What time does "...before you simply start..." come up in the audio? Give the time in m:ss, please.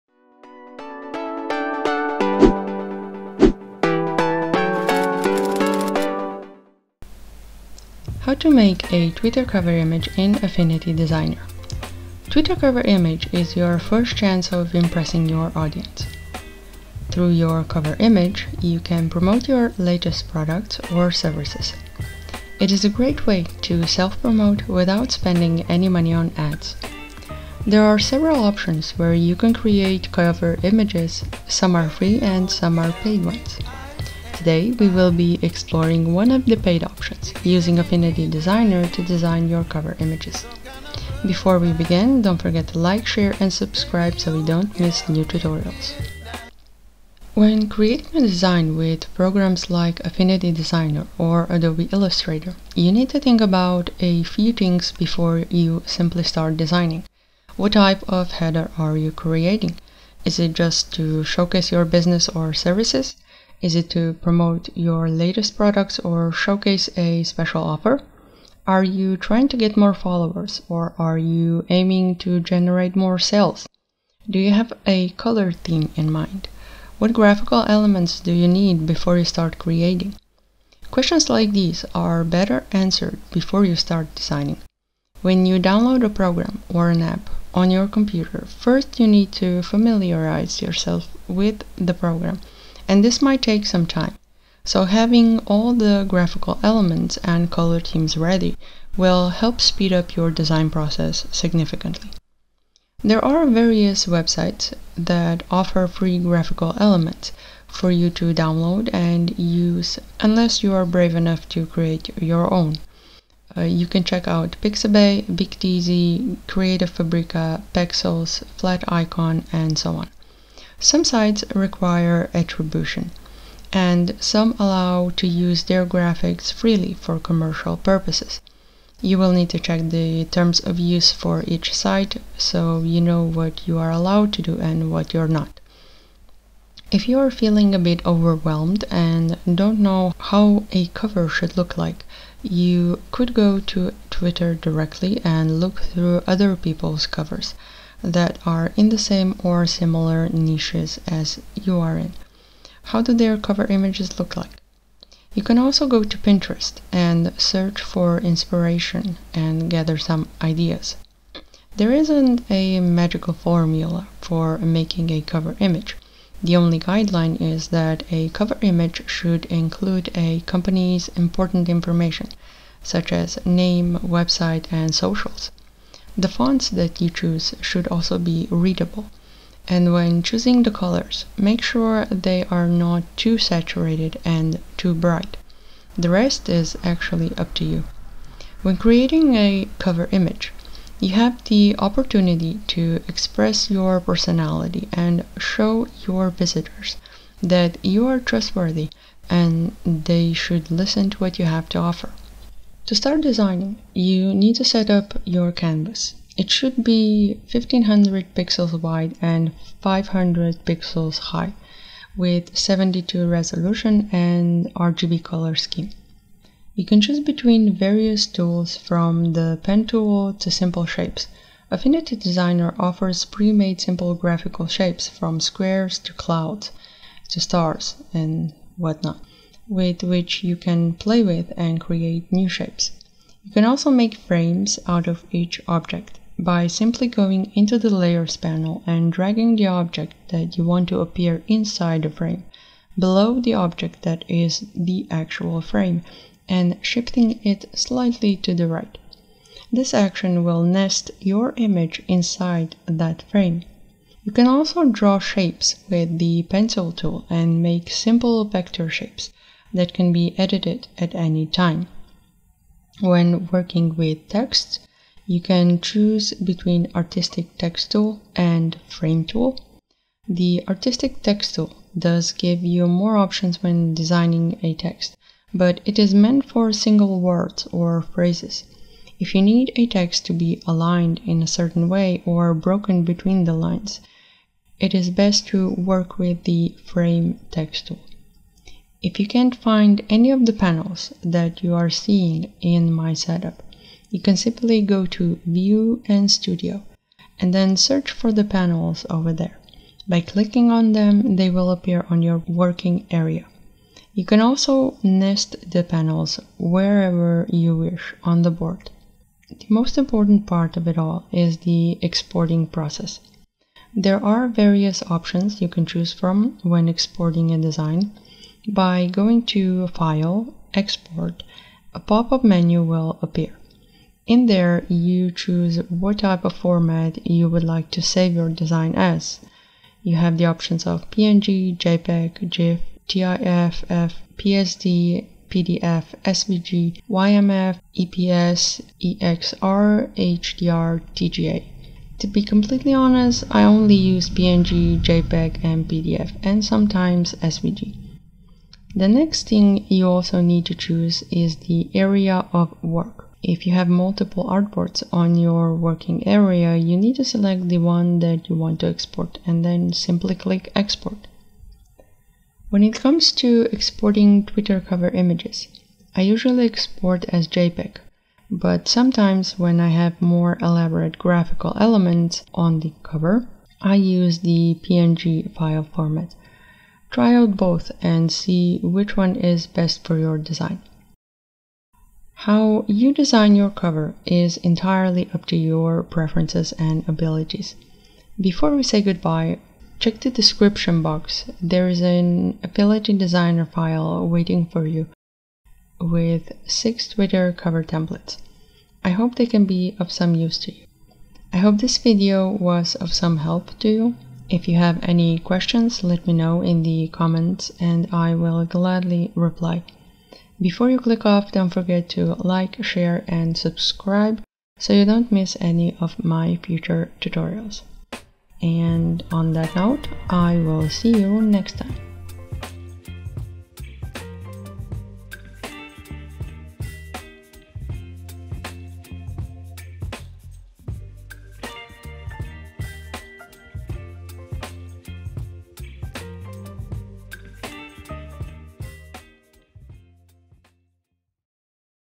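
0:54.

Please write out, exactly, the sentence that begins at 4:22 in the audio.
When working with text, you can choose between Artistic Text Tool and Frame Tool.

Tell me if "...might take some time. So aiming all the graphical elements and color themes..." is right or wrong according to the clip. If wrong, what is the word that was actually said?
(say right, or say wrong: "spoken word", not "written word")
wrong: "having", not "aiming".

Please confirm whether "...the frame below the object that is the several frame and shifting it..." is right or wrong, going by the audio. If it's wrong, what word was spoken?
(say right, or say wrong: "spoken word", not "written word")
wrong: "actual", not "several".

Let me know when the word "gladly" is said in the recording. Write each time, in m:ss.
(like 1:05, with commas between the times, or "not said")
6:48.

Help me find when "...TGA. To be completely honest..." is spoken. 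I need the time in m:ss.
5:41.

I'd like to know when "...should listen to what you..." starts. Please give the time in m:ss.
3:20.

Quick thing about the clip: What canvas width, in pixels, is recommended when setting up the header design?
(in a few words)
1500.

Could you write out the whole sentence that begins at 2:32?
How do their cover images look like?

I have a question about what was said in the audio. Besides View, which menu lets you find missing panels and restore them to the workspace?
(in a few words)
Studio.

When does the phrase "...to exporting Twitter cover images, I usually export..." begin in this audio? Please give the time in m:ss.
6:03.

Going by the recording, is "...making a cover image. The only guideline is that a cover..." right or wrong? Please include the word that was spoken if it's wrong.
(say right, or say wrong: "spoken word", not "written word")
right.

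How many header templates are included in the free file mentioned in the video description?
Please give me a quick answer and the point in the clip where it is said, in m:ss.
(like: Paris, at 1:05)
6, at 6:36.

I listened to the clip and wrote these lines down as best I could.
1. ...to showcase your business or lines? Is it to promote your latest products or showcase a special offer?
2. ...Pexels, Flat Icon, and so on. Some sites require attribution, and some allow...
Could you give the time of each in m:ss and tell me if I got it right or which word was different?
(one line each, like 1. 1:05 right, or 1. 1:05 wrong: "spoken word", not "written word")
1. 1:00 wrong: "services", not "lines"
2. 1:57 right.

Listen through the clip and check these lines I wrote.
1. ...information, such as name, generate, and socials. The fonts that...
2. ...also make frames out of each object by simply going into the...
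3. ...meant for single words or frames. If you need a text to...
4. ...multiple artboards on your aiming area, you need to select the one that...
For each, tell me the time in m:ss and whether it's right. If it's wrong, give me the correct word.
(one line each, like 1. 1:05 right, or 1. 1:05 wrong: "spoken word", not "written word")
1. 2:51 wrong: "website", not "generate"
2. 3:53 right
3. 4:36 wrong: "phrases", not "frames"
4. 5:53 wrong: "working", not "aiming".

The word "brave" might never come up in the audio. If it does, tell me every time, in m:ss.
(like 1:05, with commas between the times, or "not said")
1:50.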